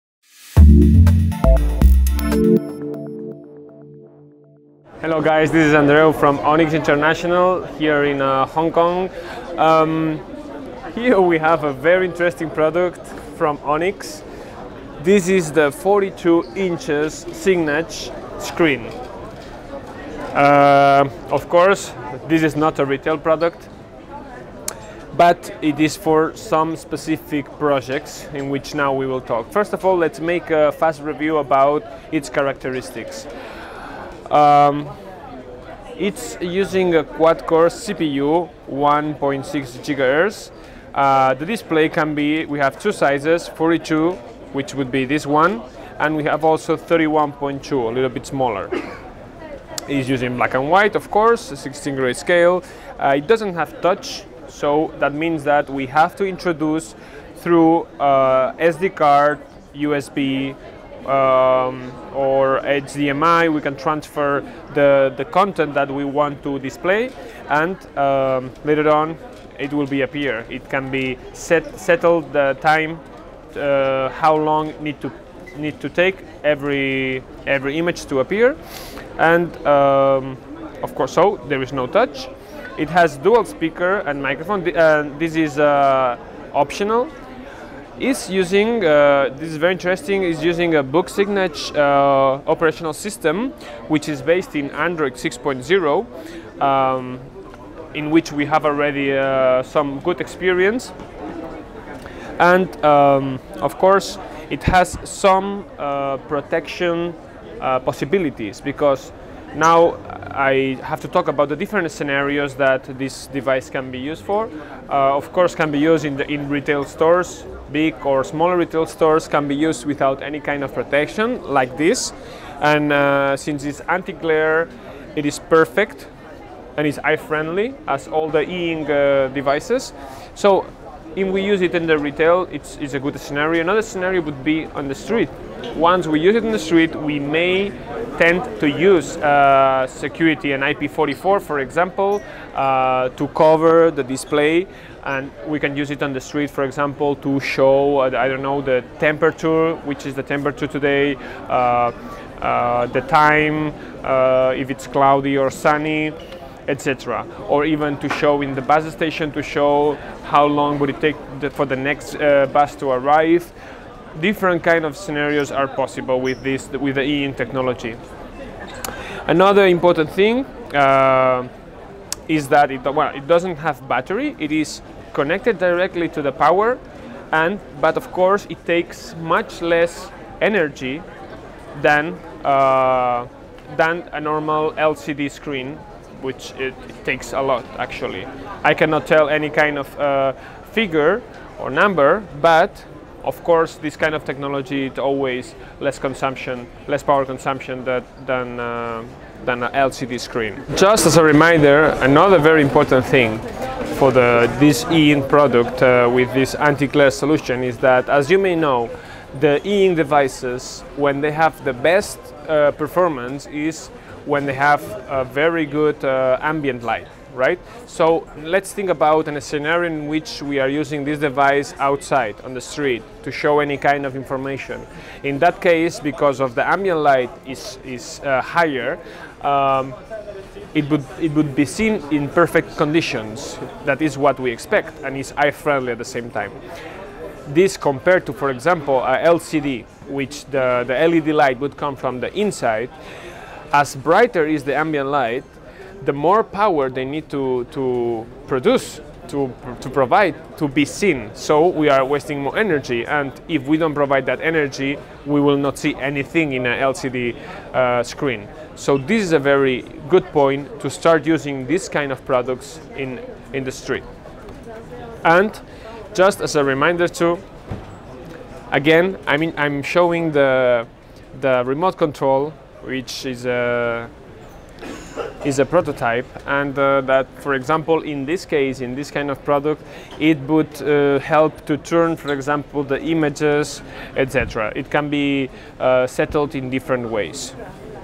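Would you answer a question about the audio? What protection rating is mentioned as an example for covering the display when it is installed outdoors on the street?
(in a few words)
IP44.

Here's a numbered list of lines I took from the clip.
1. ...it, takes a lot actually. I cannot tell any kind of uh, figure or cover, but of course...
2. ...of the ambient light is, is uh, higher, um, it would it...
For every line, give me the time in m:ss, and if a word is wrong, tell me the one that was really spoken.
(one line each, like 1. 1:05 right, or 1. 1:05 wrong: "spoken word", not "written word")
1. 3:06 wrong: "number", not "cover"
2. 3:46 right.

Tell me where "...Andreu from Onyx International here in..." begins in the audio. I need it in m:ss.
0:05.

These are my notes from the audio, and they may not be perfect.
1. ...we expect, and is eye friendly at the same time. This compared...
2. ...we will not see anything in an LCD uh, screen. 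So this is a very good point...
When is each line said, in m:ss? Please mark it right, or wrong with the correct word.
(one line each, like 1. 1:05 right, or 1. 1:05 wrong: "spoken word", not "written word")
1. 3:54 right
2. 4:15 right.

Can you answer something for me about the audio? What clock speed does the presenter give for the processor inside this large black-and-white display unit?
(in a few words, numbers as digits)
1.6 gigahertz.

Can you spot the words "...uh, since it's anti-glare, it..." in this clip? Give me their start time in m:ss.
2:02.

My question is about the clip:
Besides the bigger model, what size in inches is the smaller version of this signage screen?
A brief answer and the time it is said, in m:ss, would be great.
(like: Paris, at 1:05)
31.2, at 0:46.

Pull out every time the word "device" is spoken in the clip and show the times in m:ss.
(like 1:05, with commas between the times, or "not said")
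1:53, 2:09, 3:29, 3:41.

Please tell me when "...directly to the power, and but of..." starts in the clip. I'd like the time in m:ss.
2:55.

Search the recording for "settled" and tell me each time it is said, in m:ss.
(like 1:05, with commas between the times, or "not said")
1:11, 4:46.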